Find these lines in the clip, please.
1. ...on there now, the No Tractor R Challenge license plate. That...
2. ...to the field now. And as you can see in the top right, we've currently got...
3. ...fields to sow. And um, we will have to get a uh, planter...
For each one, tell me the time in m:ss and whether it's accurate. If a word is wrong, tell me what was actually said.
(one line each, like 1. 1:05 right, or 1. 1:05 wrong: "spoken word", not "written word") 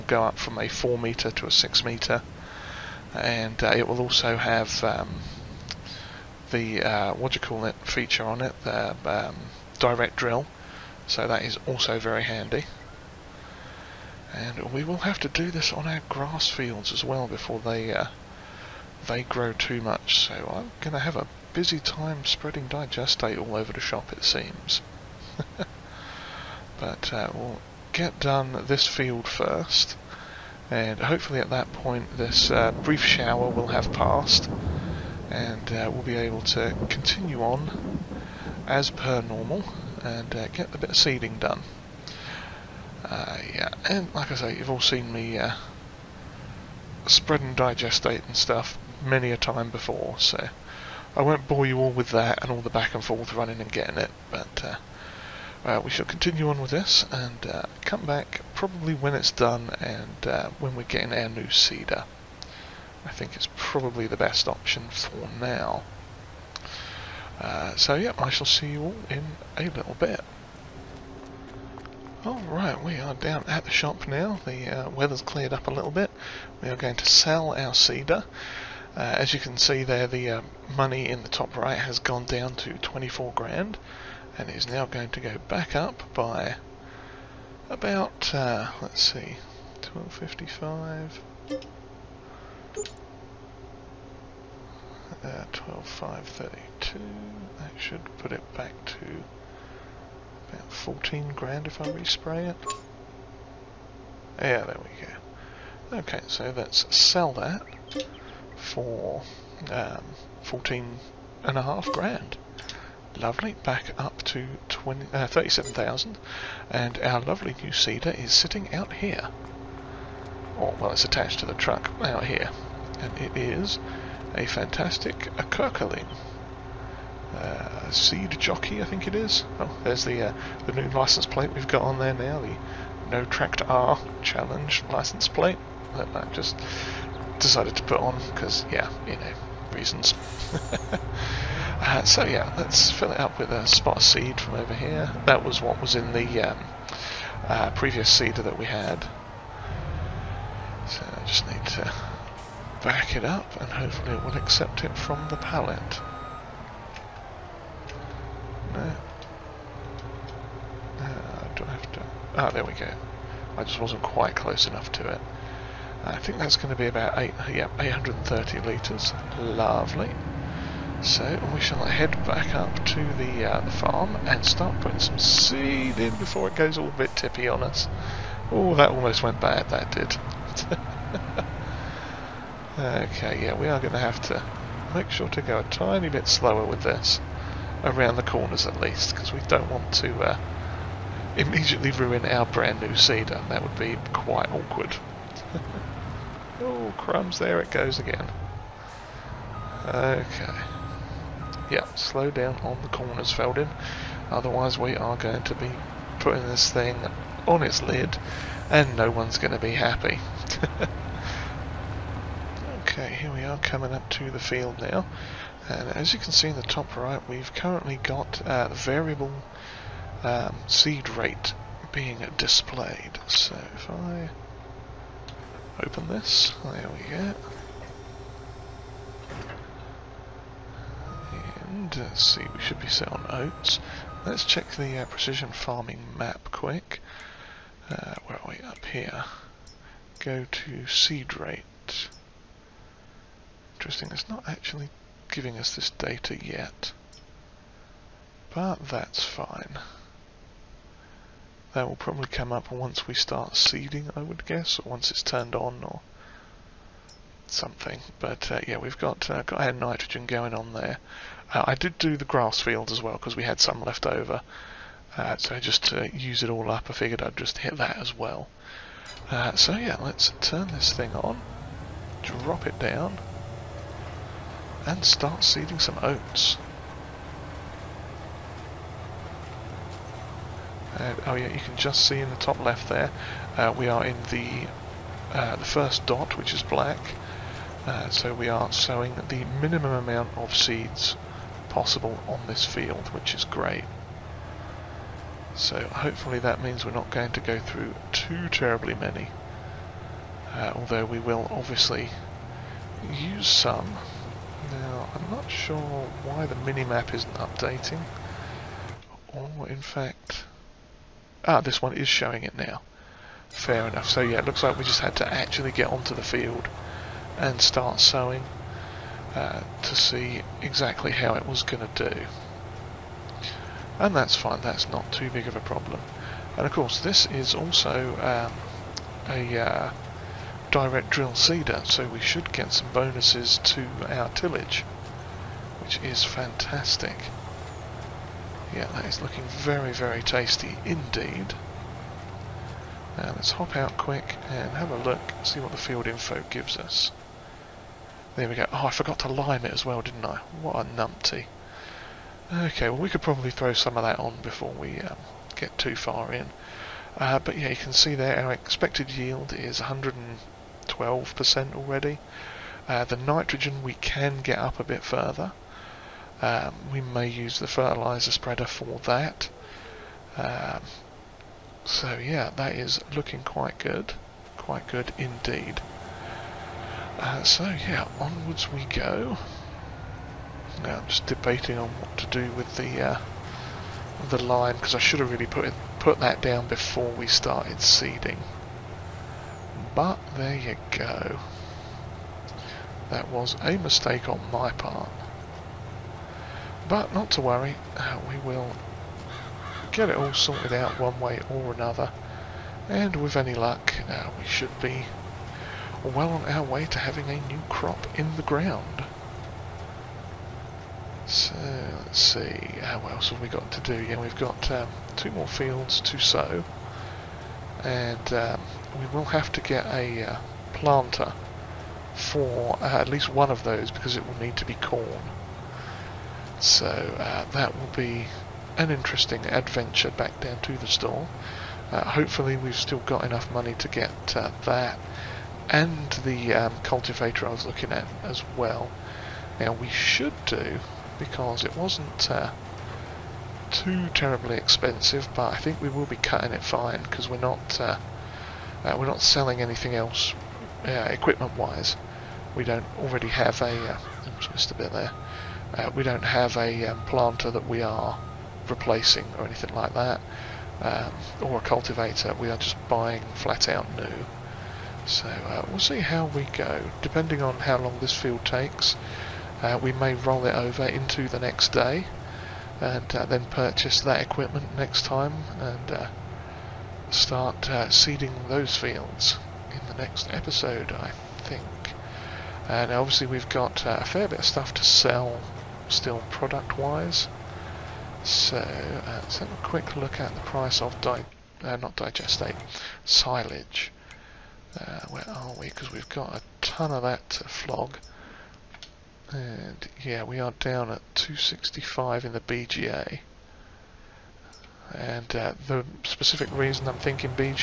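1. 2:11 right
2. 3:34 right
3. 6:55 right.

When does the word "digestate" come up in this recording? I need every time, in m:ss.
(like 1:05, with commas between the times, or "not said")
0:22, 0:47, 8:11.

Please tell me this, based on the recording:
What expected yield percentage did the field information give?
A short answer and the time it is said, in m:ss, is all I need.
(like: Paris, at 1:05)
112%, at 5:59.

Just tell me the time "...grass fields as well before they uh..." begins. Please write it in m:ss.
0:16.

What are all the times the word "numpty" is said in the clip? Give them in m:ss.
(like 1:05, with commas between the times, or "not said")
5:50.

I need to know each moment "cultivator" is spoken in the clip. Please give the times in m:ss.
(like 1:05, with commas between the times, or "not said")
7:16, 7:41.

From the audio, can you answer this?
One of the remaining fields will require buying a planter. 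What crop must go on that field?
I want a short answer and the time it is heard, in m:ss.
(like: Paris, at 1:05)
Corn, at 7:04.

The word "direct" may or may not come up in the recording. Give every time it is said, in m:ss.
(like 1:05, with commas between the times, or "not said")
0:09, 5:30.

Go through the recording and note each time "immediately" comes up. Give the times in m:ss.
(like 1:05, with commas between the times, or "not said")
3:11.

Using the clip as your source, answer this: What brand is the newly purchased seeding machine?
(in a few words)
Köckerling.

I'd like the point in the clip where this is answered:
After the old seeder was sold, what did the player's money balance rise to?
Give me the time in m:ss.
1:55.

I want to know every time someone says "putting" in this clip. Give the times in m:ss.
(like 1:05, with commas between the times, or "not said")
2:54, 3:26.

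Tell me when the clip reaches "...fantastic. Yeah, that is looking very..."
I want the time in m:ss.
5:36.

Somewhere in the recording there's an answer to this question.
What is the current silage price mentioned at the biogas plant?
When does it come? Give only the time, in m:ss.
8:21.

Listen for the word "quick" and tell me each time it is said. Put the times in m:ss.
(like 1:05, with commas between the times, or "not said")
3:56, 5:43, 8:09.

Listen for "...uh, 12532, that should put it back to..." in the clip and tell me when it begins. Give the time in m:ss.
1:35.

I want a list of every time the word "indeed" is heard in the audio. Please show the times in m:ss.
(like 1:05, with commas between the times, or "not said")
5:40, 6:15.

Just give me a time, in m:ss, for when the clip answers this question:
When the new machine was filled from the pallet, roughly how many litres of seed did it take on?
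2:47.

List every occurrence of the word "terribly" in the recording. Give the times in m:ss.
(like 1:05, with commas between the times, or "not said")
4:58, 7:24.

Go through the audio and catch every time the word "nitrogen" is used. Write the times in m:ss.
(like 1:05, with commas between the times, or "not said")
4:19, 6:03.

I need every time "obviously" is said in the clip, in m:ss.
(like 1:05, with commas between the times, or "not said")
5:01, 8:02.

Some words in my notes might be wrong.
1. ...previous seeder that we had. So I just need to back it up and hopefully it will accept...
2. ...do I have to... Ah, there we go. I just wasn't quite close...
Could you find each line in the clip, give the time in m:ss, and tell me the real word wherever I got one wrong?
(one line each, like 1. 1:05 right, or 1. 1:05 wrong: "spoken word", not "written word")
1. 2:27 right
2. 2:41 right.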